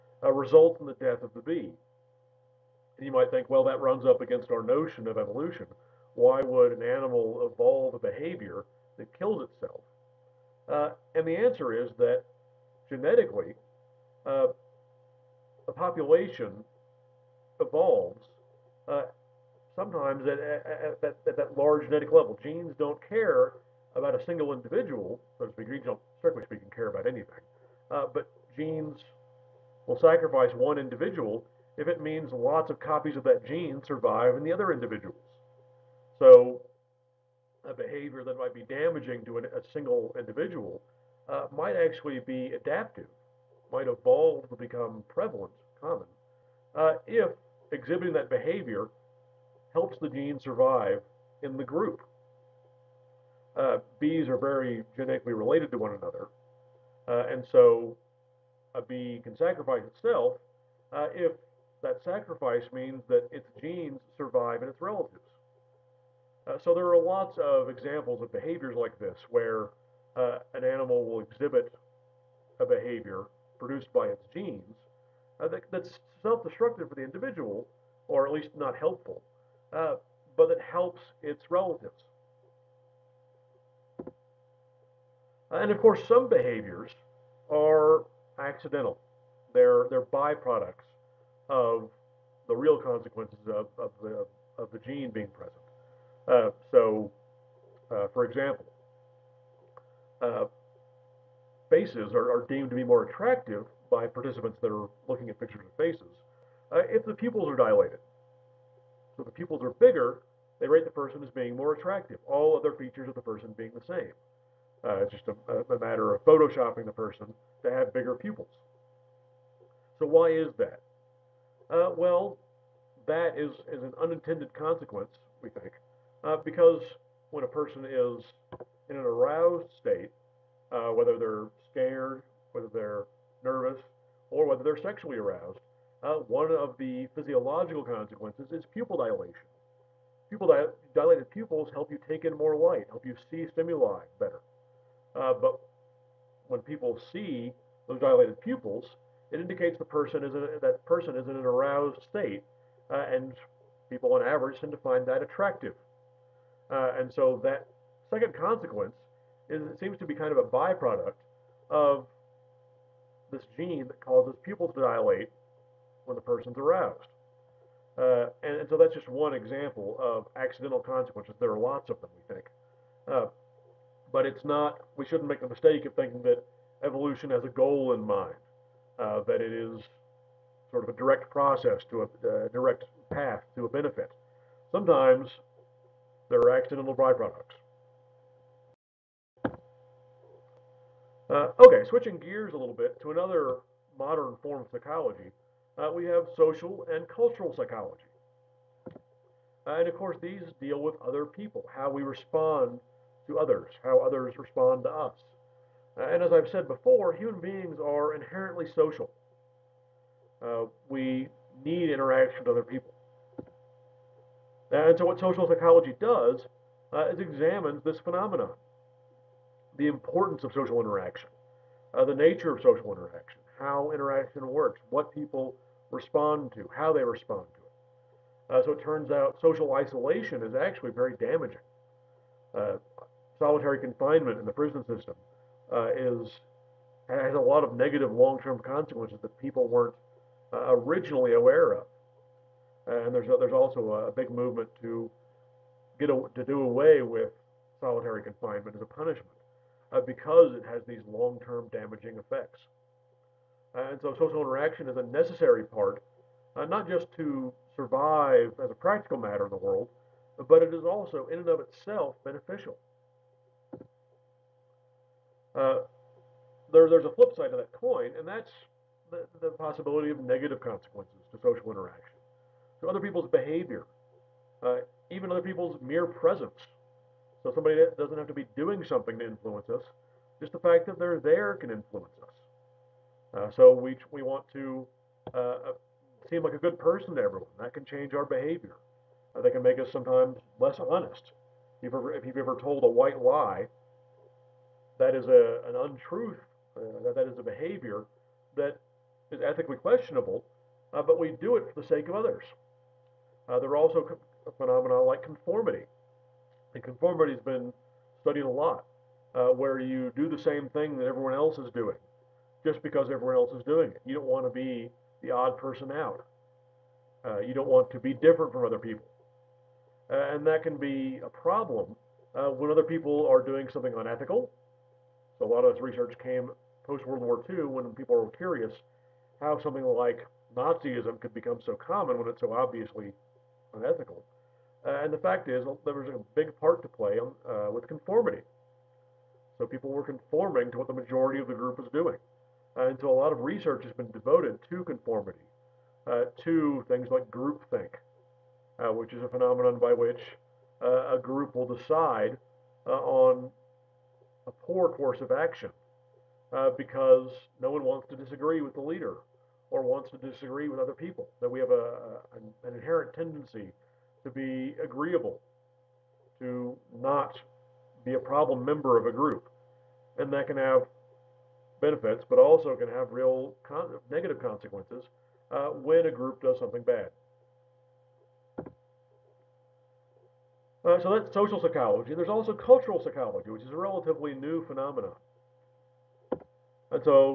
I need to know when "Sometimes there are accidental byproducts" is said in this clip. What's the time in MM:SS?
03:04.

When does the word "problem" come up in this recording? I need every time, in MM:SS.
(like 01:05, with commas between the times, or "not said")
05:21, 06:08.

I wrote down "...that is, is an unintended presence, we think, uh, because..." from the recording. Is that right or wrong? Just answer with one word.
wrong.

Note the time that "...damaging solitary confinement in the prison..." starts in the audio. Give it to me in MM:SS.
03:51.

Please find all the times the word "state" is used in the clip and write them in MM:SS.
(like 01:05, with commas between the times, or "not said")
02:09, 02:32.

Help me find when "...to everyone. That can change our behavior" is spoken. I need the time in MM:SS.
04:47.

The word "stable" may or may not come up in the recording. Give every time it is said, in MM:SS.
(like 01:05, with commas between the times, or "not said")
not said.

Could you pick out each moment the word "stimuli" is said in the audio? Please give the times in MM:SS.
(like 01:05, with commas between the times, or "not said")
02:23.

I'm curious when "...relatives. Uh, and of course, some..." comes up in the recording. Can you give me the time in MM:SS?
01:21.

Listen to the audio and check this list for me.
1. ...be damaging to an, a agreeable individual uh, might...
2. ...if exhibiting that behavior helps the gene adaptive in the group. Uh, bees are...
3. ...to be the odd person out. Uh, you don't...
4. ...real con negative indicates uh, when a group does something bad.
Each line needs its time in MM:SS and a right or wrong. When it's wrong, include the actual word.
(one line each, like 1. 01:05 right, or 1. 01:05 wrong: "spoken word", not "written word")
1. 00:38 wrong: "single", not "agreeable"
2. 00:47 wrong: "survive", not "adaptive"
3. 05:14 right
4. 06:13 wrong: "consequences", not "indicates".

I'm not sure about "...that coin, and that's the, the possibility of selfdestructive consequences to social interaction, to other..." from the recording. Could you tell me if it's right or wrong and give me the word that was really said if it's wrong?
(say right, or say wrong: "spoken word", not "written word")
wrong: "negative", not "selfdestructive".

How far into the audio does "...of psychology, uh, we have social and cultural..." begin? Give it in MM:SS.
03:14.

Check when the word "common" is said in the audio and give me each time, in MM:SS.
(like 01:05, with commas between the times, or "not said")
00:45, 05:31.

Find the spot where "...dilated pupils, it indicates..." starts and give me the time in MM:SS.
02:27.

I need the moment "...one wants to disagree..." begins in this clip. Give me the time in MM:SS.
05:57.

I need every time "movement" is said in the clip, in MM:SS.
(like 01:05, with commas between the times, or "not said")
04:04.